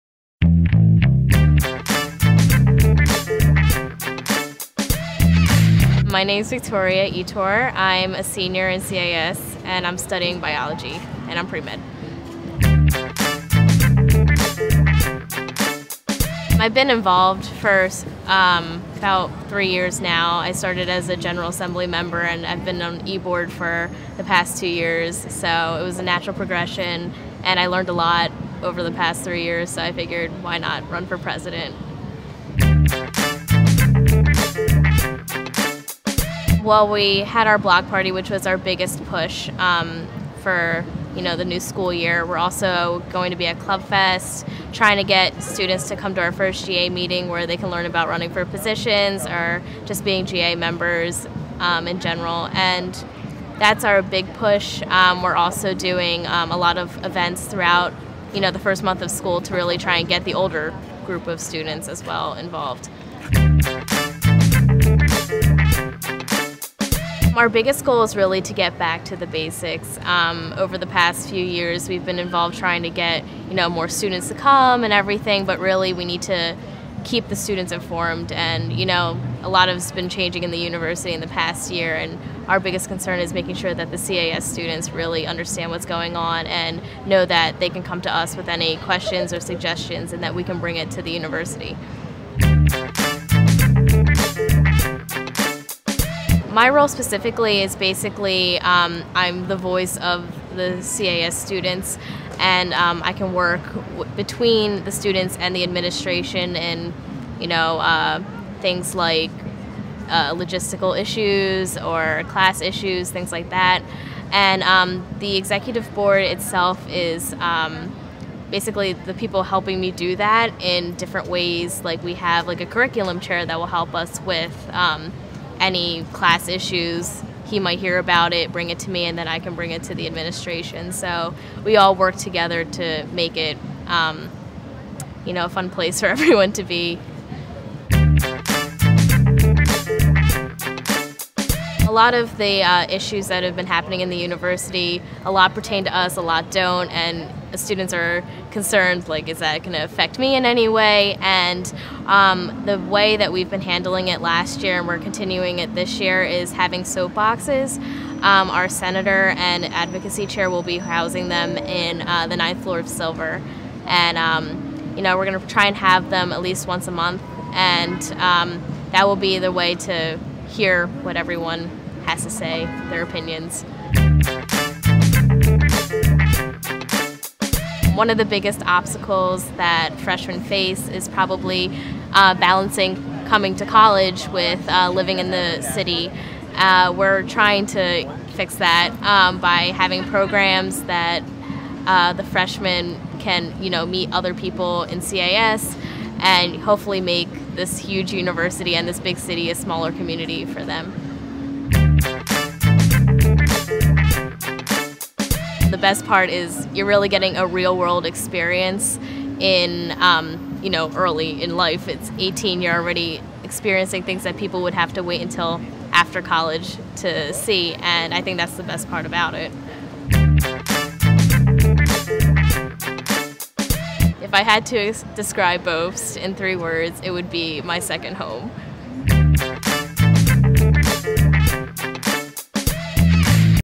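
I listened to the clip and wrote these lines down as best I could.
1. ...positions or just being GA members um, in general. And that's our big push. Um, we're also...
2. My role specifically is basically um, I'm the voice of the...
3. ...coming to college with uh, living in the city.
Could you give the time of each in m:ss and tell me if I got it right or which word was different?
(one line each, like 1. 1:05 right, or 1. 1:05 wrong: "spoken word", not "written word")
1. 0:48 right
2. 1:36 right
3. 3:03 right.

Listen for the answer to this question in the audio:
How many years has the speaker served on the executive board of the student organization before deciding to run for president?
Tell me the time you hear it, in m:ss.
0:24.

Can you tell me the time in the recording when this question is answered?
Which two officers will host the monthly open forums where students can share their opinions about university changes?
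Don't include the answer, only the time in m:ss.
2:38.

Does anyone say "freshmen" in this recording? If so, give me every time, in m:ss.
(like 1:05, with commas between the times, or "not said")
2:59, 3:12.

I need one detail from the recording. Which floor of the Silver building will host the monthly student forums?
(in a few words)
ninth floor.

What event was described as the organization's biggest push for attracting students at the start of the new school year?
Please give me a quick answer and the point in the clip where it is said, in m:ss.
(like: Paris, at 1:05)
block party, at 0:37.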